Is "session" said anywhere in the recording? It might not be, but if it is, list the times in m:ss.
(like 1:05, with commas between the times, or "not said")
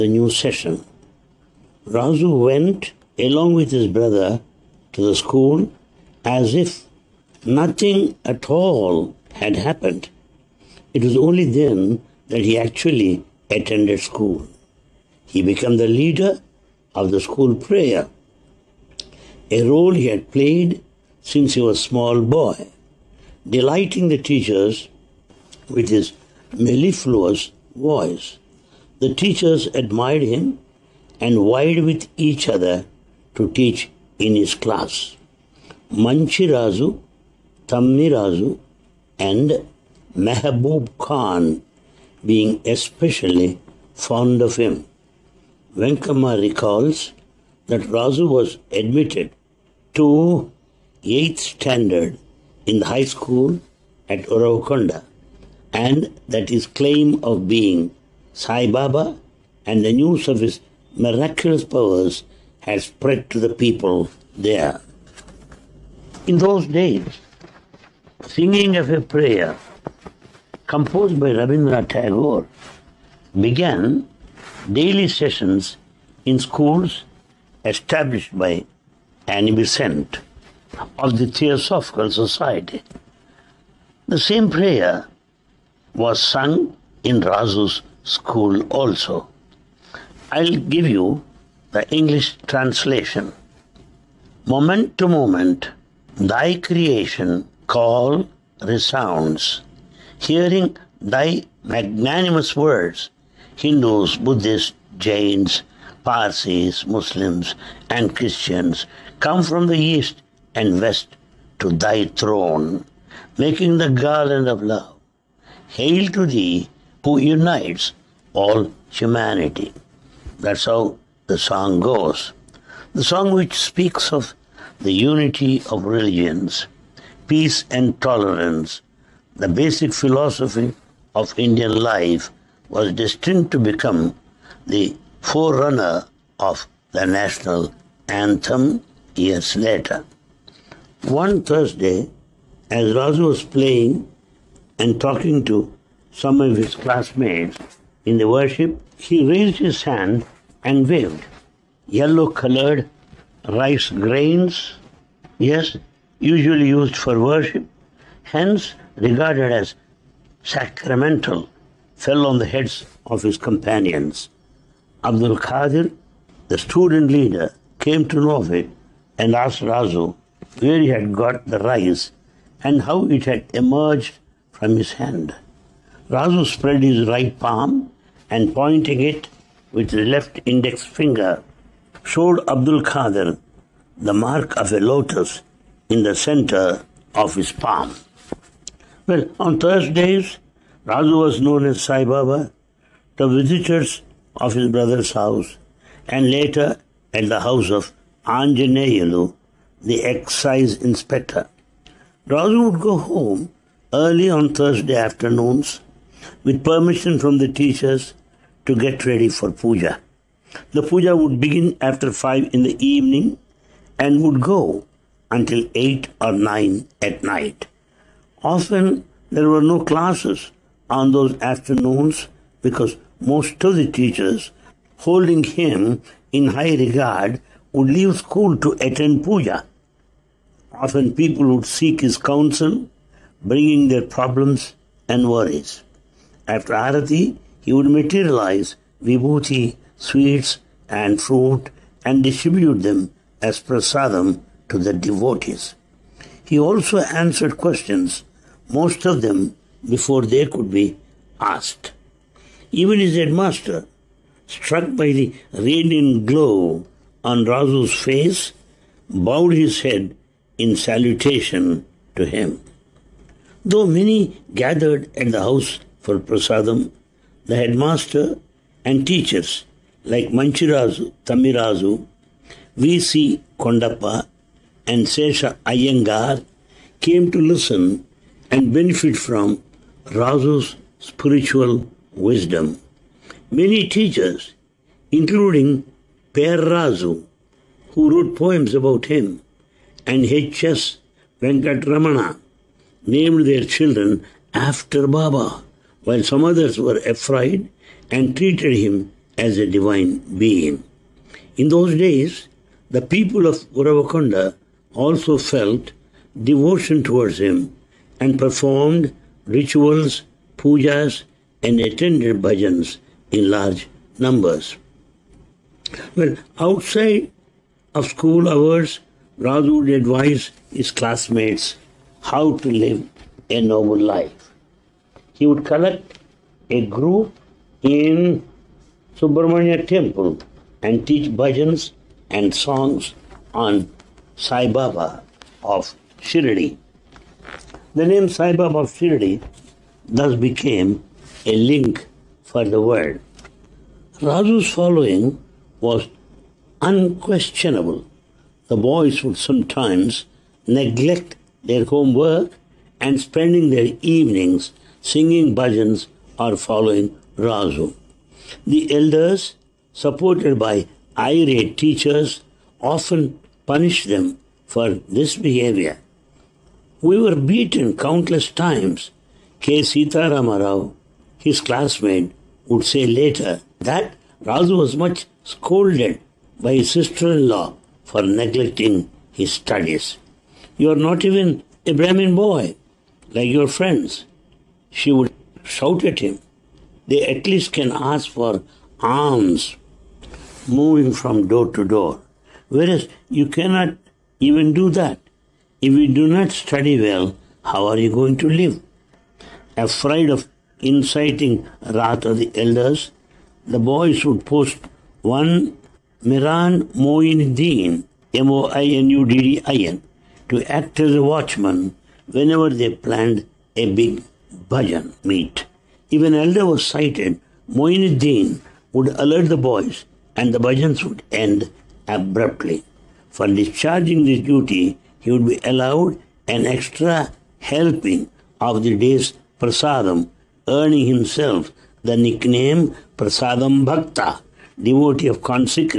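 0:00, 1:15.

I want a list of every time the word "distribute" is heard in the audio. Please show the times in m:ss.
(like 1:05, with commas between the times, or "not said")
4:02.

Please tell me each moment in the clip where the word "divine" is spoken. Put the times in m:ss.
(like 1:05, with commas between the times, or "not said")
4:59.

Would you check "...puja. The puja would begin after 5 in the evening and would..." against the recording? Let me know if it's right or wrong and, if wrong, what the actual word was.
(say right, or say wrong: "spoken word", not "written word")
right.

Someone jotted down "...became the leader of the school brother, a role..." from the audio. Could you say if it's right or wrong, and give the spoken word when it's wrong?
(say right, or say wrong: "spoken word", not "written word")
wrong: "prayer", not "brother".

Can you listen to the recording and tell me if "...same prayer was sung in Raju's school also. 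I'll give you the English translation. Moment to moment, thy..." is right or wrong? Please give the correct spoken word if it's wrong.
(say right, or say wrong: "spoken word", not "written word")
right.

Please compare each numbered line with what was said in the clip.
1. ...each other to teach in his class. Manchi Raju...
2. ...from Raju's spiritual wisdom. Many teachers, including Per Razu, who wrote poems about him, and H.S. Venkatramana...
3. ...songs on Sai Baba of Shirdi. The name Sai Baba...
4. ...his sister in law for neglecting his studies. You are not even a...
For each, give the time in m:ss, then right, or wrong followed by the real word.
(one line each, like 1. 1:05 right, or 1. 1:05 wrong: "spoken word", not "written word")
1. 0:32 right
2. 4:39 right
3. 5:32 right
4. 6:16 right.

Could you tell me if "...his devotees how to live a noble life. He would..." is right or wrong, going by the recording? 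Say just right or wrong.
wrong.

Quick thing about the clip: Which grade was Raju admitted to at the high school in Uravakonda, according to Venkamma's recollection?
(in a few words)
8th standard.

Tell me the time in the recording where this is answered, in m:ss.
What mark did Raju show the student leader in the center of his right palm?
3:04.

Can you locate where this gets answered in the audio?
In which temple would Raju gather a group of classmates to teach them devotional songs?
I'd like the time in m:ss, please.
5:29.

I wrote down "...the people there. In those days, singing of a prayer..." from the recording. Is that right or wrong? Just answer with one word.
right.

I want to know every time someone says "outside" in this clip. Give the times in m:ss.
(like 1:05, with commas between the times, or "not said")
5:16.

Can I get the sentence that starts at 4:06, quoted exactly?
He also answered questions most of them before they could be asked.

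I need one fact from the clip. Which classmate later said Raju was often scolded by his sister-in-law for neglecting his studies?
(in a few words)
K. Sitarama Rao.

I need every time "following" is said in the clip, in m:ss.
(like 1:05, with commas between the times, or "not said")
5:44, 5:56.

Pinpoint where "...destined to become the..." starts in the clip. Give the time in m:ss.
2:12.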